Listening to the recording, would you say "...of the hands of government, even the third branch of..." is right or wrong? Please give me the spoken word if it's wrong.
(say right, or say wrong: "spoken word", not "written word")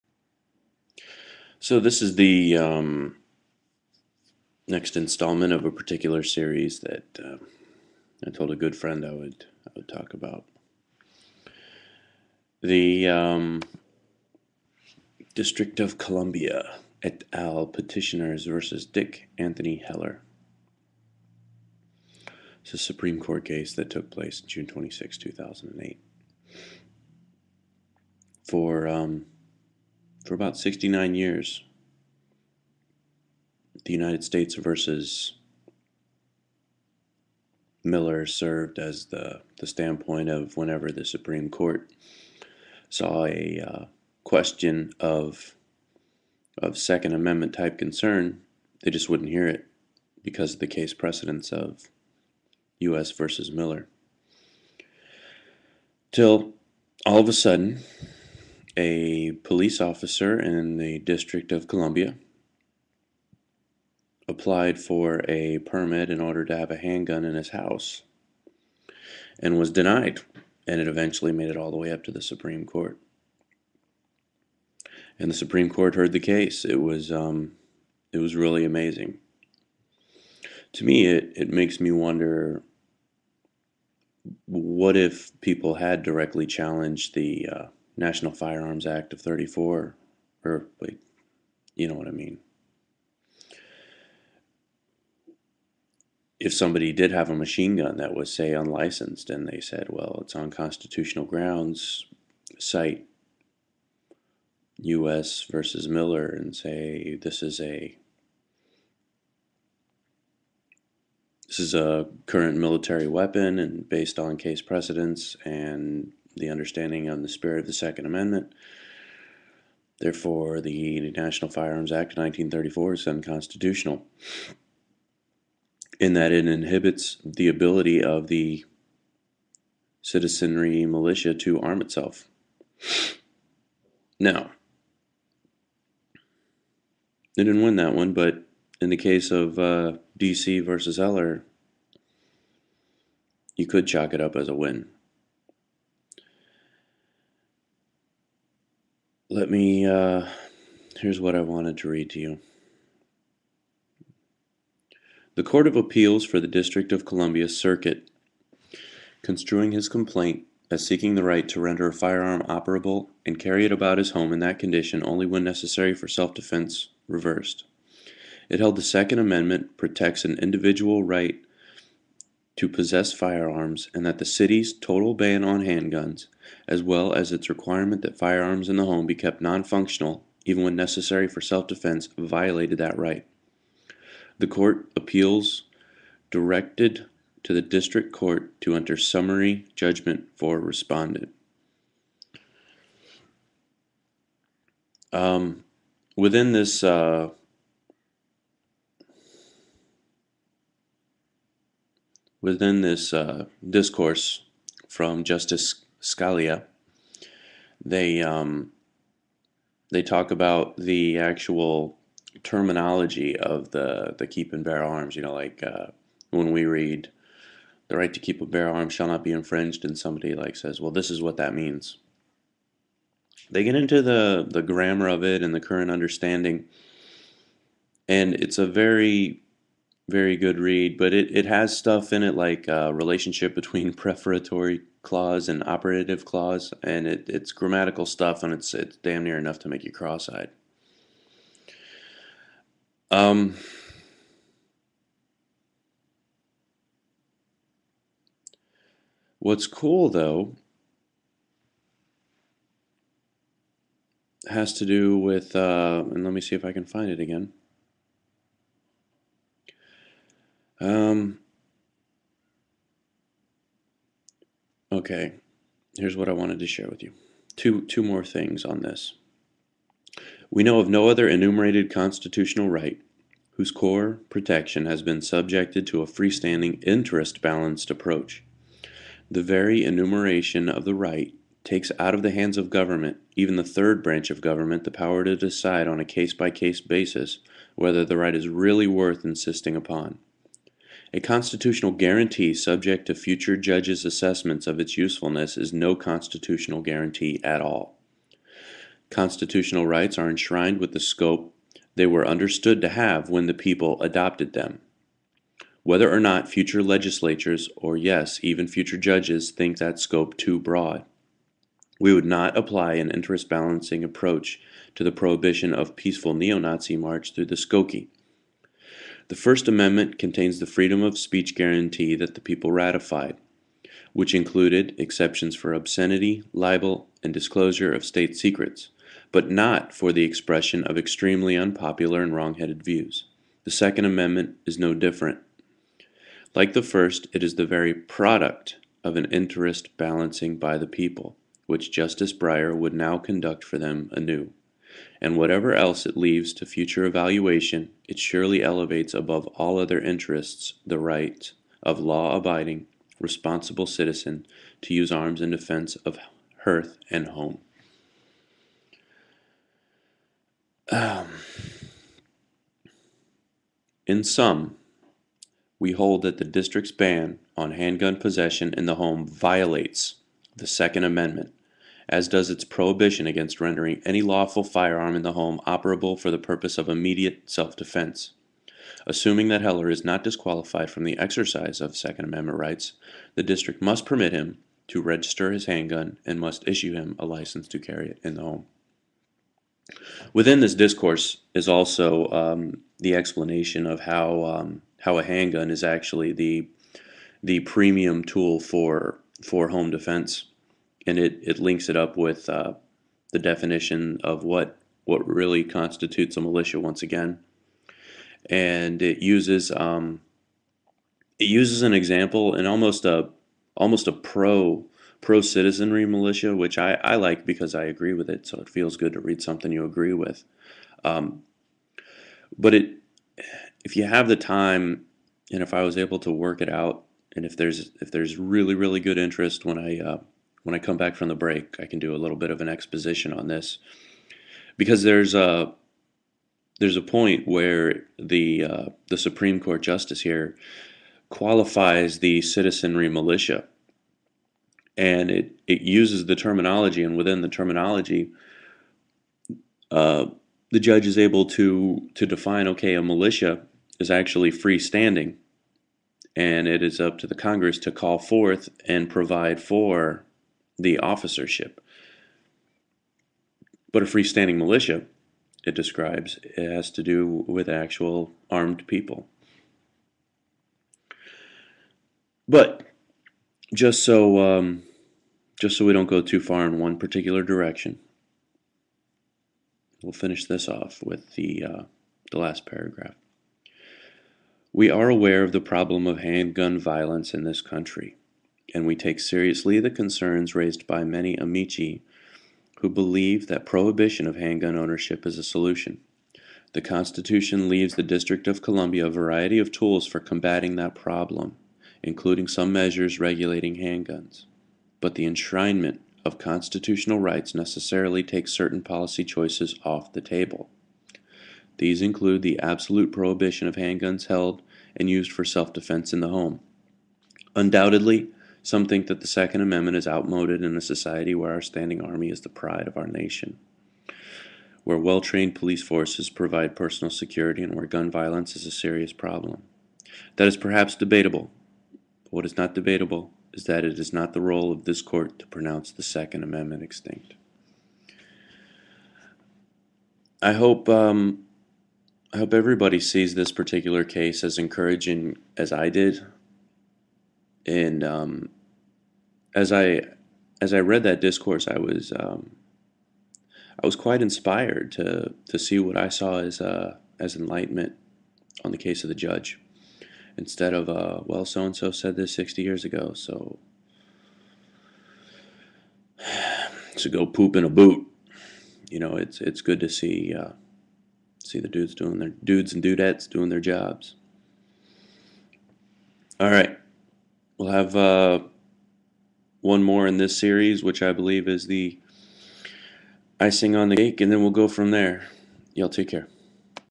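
right.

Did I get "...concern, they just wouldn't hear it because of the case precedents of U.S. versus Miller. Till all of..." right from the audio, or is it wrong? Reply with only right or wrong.
right.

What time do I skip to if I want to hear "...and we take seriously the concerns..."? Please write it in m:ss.
8:08.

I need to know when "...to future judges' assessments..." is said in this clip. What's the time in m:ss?
4:53.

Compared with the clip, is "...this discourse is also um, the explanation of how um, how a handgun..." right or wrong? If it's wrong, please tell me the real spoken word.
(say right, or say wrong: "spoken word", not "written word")
right.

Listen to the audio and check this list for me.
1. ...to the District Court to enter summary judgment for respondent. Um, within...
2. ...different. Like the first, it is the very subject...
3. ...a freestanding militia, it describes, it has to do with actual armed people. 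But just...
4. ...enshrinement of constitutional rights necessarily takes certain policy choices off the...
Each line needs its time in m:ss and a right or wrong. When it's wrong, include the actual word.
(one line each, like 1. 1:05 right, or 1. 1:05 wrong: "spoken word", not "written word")
1. 3:07 right
2. 5:34 wrong: "product", not "subject"
3. 7:44 right
4. 8:25 right.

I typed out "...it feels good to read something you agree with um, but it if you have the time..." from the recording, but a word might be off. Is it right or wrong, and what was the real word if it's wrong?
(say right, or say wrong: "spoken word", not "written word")
right.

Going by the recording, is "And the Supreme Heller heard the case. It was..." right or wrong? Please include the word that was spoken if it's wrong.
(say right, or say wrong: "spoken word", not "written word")
wrong: "Court", not "Heller".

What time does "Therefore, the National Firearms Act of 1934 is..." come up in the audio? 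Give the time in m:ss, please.
1:59.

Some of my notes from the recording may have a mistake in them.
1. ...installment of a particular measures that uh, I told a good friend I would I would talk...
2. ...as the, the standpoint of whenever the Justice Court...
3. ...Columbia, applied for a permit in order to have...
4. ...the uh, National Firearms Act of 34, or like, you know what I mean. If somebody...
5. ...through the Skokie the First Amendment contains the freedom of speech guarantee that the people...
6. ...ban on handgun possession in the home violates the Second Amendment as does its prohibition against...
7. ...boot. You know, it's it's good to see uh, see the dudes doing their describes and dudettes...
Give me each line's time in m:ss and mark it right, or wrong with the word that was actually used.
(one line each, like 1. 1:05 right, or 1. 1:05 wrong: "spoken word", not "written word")
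1. 0:04 wrong: "series", not "measures"
2. 0:38 wrong: "Supreme", not "Justice"
3. 1:01 right
4. 1:27 right
5. 5:17 right
6. 6:06 right
7. 9:27 wrong: "dudes", not "describes".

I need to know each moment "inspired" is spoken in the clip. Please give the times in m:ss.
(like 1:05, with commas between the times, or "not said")
9:14.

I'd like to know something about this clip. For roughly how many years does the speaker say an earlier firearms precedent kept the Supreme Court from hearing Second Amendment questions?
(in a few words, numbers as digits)
69.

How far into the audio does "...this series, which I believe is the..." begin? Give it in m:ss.
9:40.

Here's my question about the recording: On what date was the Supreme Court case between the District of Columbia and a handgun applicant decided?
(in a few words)
June 26, 2008.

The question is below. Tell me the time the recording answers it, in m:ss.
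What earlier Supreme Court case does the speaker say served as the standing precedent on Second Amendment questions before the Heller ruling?
0:33.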